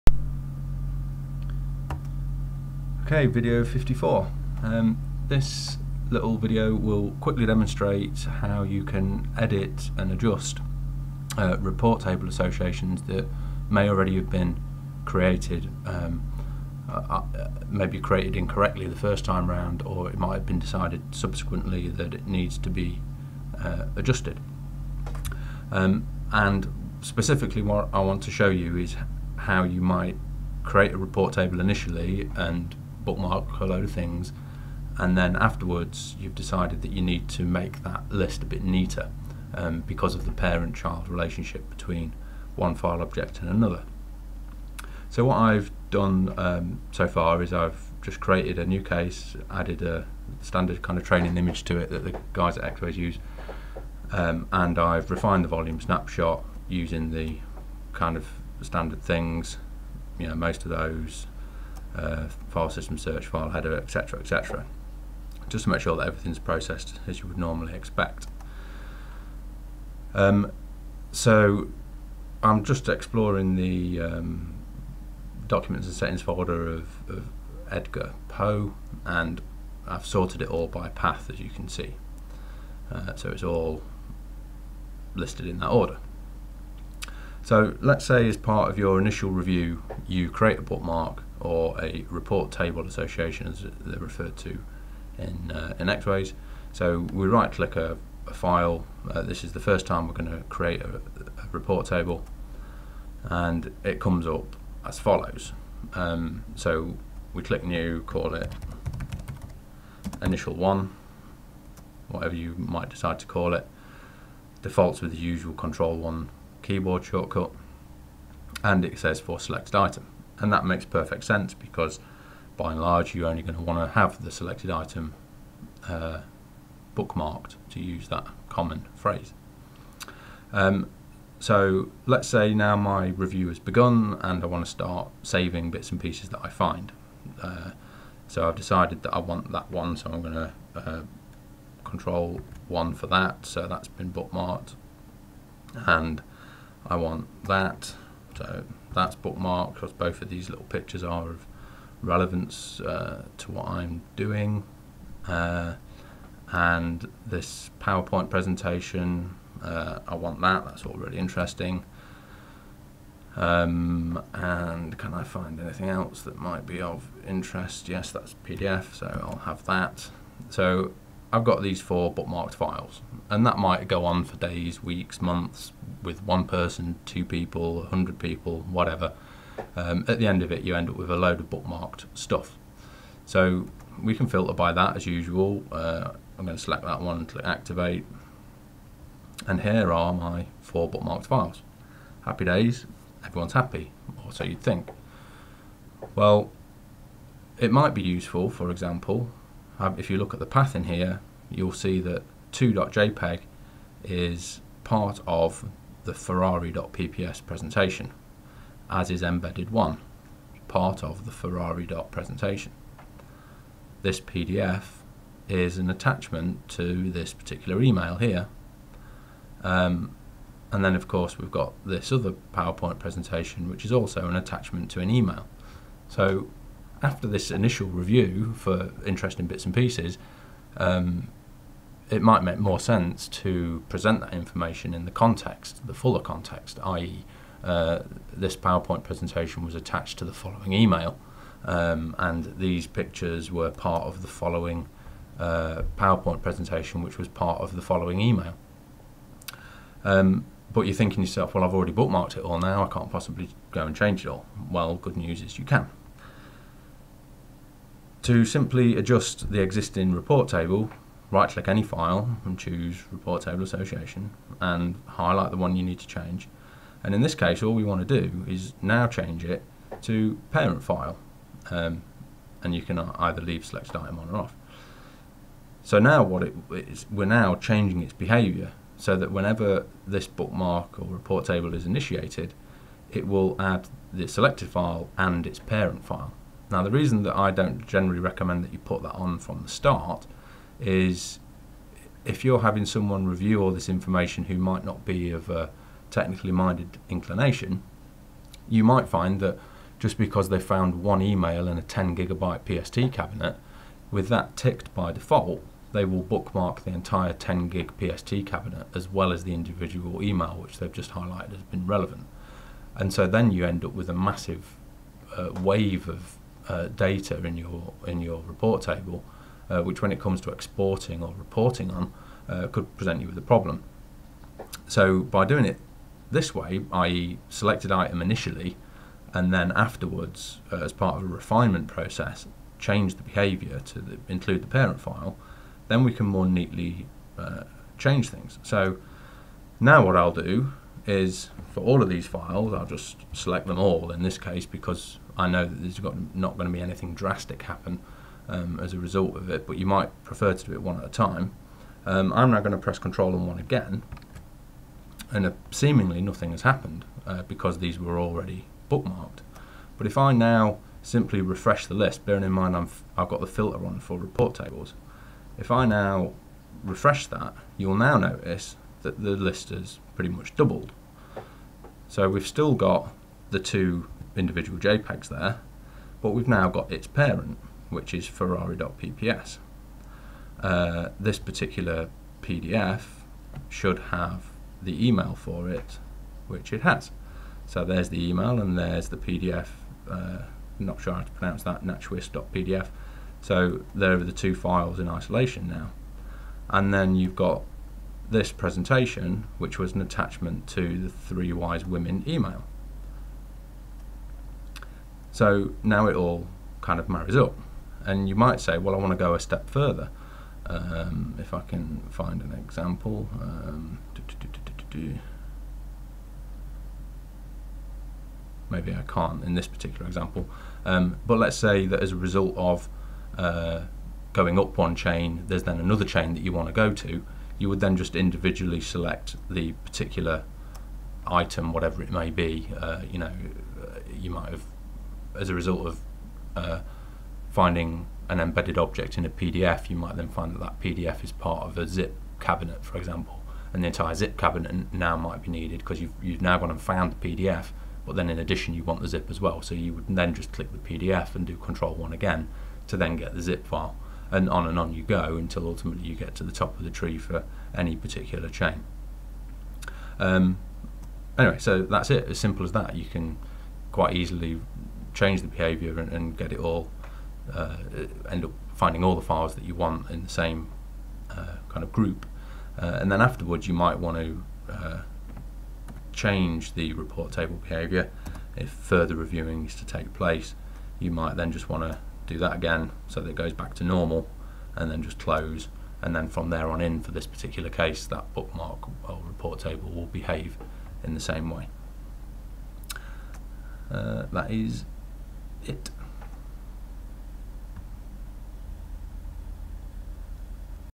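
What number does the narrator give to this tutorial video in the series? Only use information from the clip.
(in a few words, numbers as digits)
54.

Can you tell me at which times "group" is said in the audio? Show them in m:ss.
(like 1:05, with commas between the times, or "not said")
7:51.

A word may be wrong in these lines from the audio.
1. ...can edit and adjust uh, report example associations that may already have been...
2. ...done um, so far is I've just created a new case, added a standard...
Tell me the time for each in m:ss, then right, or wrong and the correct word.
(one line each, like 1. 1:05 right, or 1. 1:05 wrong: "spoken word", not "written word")
1. 0:08 wrong: "table", not "example"
2. 0:45 right.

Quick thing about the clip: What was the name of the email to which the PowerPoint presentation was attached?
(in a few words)
Three Wise Women.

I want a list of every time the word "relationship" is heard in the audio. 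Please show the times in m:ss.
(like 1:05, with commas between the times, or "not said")
0:41.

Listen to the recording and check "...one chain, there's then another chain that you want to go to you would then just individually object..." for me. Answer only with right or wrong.
wrong.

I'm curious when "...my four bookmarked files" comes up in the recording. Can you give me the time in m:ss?
3:10.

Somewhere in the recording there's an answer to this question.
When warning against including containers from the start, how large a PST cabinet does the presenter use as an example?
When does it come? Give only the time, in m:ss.
5:01.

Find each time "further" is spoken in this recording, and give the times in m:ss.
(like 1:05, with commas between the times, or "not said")
6:49, 7:58.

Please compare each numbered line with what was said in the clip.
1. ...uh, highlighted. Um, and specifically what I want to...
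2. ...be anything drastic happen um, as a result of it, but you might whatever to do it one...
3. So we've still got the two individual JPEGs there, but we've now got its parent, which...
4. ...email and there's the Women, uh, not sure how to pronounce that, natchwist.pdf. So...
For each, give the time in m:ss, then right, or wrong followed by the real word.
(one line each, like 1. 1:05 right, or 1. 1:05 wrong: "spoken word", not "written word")
1. 0:23 wrong: "adjusted", not "highlighted"
2. 5:46 wrong: "prefer", not "whatever"
3. 6:12 right
4. 6:28 wrong: "PDF", not "Women".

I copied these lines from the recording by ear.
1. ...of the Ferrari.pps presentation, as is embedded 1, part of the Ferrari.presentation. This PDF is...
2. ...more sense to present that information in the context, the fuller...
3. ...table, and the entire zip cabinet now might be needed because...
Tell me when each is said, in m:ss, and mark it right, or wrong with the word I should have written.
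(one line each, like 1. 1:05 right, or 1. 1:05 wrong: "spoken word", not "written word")
1. 3:25 right
2. 3:52 right
3. 7:22 wrong: "example", not "table".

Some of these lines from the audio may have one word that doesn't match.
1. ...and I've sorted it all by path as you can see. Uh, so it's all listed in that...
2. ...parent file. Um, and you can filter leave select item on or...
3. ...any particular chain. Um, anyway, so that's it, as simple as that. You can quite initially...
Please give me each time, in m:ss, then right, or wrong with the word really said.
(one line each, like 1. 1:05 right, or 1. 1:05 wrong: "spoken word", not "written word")
1. 1:19 right
2. 4:30 wrong: "either", not "filter"
3. 7:37 wrong: "easily", not "initially".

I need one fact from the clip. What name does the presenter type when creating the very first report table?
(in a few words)
initial one.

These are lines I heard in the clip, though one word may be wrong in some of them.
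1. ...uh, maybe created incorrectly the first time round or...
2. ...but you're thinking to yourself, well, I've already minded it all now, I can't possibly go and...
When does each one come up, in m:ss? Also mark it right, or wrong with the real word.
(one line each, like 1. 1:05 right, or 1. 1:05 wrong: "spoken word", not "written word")
1. 0:17 right
2. 4:10 wrong: "bookmarked", not "minded".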